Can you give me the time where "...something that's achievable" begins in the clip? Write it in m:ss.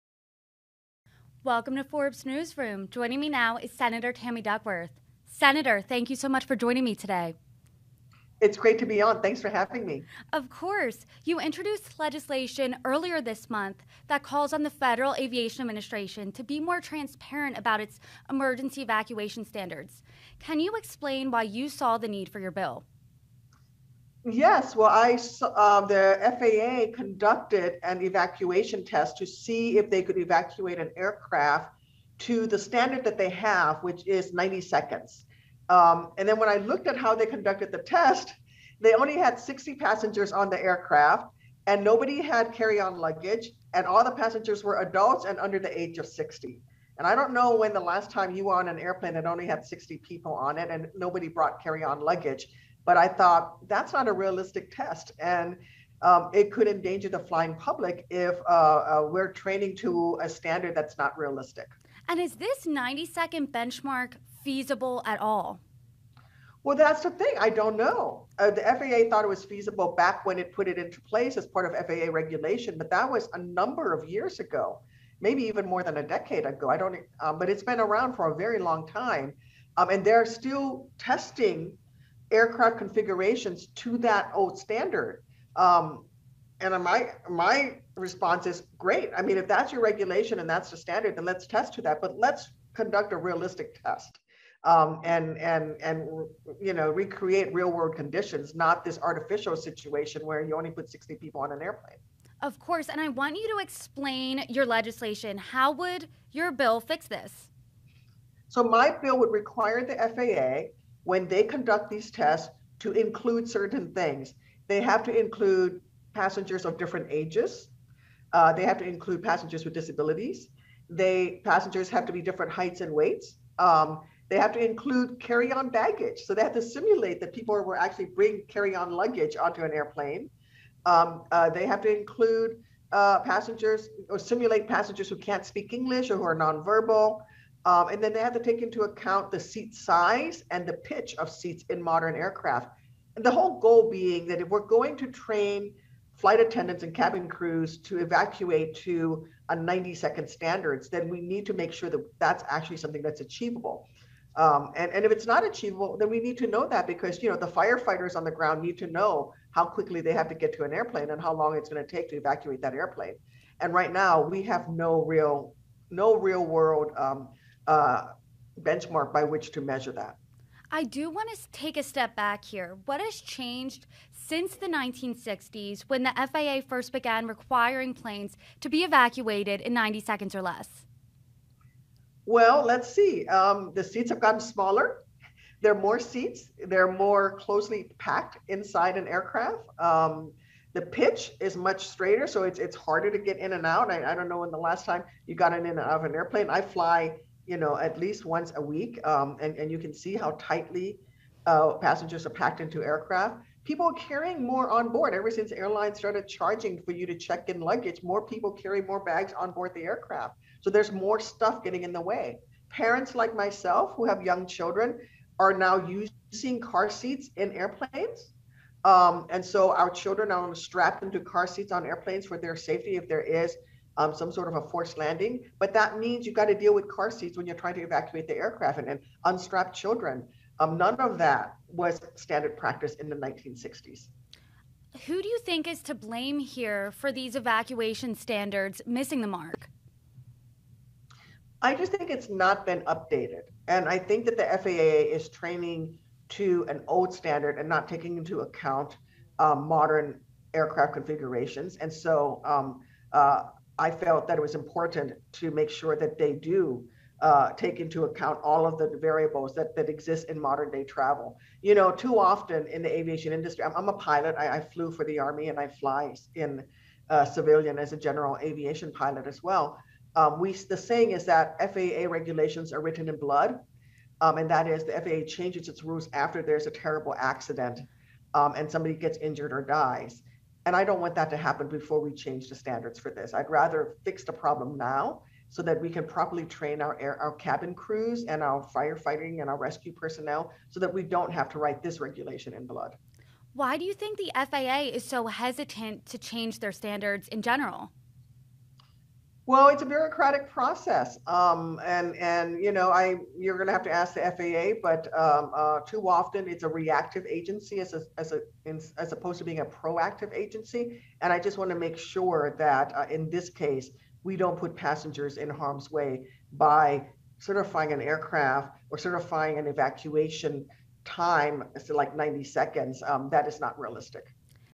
2:32.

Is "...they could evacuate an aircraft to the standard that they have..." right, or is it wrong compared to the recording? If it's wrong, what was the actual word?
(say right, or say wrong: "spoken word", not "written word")
right.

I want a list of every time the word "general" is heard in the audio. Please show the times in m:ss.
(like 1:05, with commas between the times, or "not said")
4:27, 4:57.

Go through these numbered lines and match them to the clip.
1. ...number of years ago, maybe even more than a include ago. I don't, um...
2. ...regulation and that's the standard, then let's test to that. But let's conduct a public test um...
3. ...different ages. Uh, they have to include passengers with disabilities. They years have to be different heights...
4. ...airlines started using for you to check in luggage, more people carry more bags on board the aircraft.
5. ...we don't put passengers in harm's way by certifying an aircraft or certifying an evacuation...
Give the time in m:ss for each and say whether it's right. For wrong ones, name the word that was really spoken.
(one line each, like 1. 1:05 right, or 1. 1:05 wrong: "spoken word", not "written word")
1. 1:13 wrong: "decade", not "include"
2. 1:29 wrong: "realistic", not "public"
3. 1:56 wrong: "passengers", not "years"
4. 3:25 wrong: "charging", not "using"
5. 5:14 right.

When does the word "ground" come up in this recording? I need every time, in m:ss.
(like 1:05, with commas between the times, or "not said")
2:38.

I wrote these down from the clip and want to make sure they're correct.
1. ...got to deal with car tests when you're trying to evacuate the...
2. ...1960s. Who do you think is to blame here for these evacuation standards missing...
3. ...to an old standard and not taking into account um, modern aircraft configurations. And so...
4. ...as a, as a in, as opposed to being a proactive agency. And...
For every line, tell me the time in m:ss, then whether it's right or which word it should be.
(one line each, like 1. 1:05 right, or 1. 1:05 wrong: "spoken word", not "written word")
1. 3:46 wrong: "seats", not "tests"
2. 3:53 right
3. 4:06 right
4. 5:07 right.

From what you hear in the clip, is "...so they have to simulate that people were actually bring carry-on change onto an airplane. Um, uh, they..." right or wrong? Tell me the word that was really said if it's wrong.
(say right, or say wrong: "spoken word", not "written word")
wrong: "luggage", not "change".